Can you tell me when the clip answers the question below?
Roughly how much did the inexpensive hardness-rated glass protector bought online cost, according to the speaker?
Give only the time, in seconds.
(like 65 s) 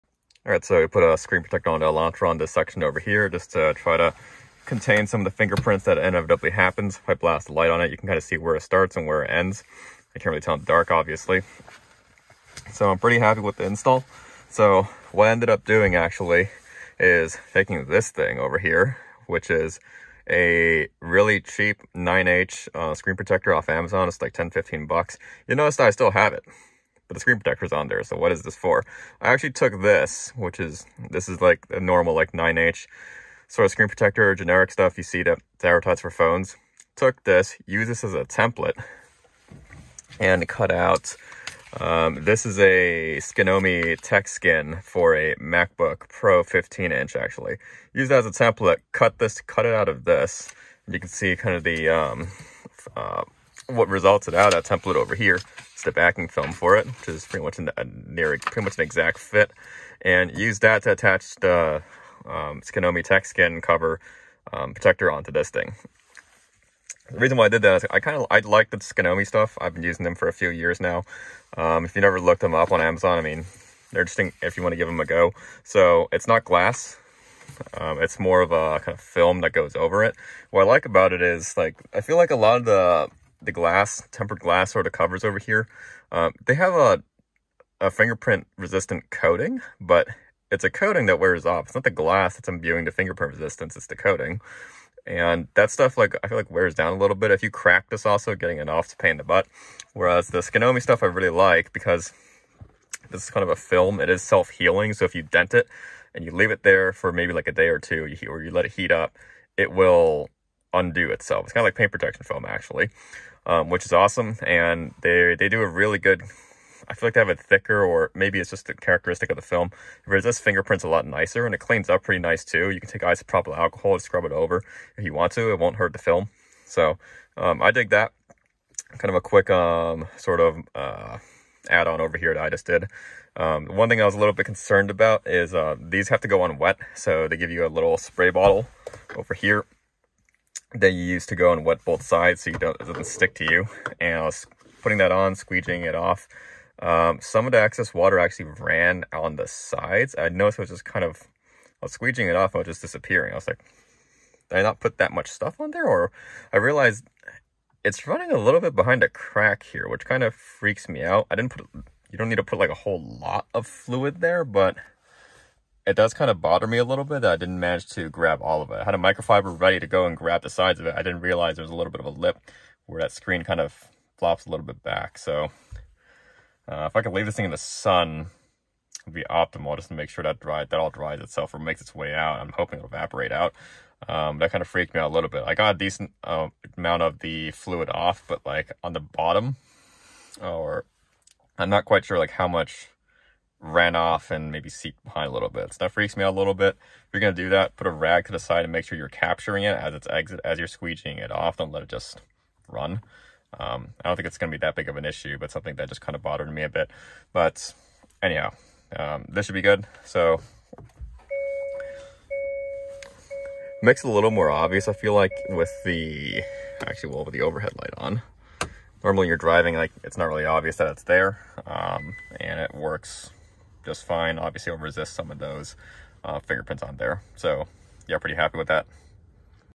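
24 s.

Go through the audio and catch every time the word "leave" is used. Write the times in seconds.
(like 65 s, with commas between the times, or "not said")
106 s, 177 s.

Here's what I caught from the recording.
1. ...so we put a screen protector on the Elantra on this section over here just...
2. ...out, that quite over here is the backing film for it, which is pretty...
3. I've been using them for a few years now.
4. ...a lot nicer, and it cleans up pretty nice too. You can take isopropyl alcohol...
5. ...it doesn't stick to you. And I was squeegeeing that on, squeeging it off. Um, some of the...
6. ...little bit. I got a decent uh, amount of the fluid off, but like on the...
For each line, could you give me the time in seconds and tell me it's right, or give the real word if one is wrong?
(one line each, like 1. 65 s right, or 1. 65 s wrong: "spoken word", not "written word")
1. 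0 s right
2. 54 s wrong: "template", not "quite"
3. 69 s right
4. 120 s right
5. 142 s wrong: "putting", not "squeegeeing"
6. 185 s right.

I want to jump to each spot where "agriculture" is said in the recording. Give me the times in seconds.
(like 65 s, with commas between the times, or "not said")
not said.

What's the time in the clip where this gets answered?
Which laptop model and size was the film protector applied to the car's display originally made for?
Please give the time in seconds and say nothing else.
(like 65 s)
45 s.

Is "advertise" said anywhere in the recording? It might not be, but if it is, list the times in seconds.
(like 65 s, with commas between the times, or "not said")
35 s.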